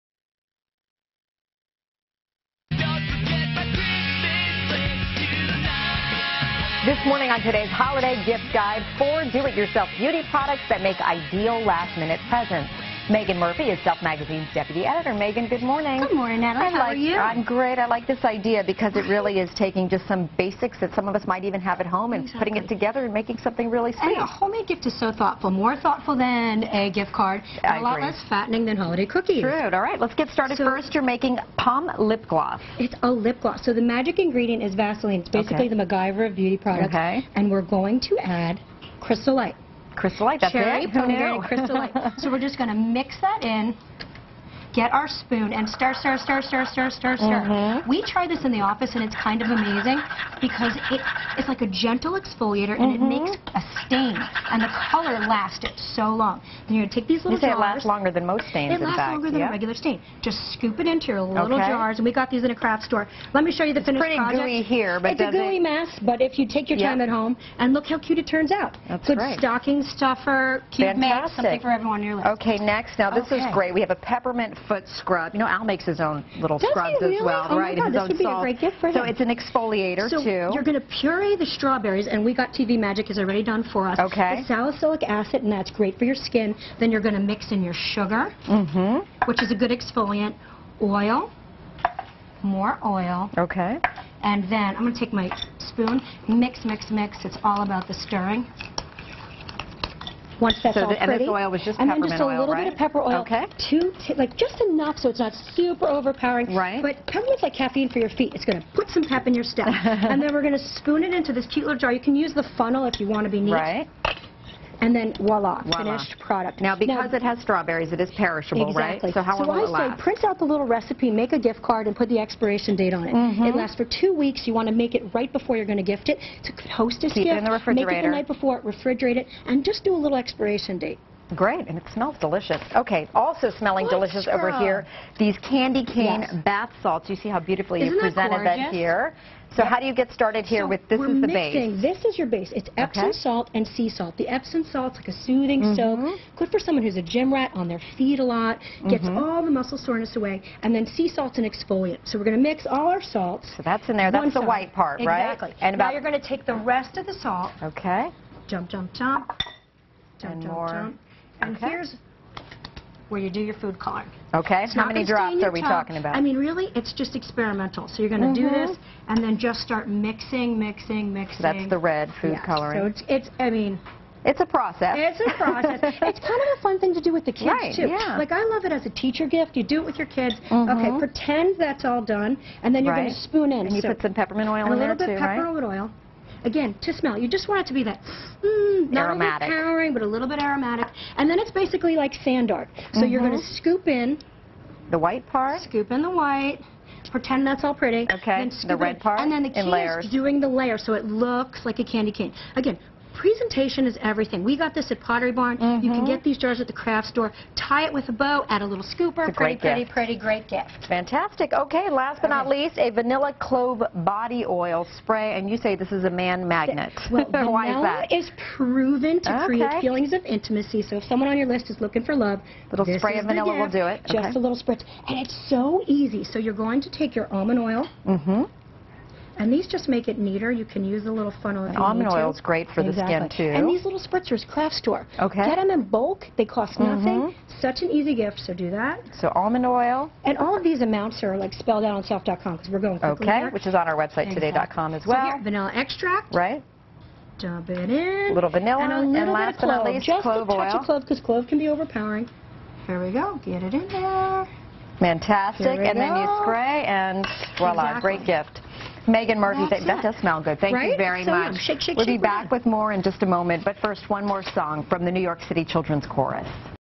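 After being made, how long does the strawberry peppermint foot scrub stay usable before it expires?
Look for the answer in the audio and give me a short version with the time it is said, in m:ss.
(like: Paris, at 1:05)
Two weeks, at 2:03.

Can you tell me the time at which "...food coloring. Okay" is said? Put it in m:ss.
2:43.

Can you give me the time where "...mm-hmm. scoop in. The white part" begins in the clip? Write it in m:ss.
3:13.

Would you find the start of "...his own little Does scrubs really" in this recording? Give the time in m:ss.
1:15.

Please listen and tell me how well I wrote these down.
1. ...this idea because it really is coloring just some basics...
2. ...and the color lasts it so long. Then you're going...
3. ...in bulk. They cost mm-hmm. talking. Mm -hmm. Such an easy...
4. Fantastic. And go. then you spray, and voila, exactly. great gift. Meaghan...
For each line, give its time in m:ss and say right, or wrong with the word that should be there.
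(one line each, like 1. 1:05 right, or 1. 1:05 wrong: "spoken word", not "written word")
1. 0:18 wrong: "taking", not "coloring"
2. 0:54 right
3. 3:55 wrong: "nothing", not "talking"
4. 4:14 right.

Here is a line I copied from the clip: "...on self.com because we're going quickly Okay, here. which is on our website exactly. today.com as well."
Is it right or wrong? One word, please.
right.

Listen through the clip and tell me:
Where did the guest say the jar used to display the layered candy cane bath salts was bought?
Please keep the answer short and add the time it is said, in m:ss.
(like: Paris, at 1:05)
Pottery Barn, at 3:24.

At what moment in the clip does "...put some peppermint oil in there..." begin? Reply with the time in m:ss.
3:03.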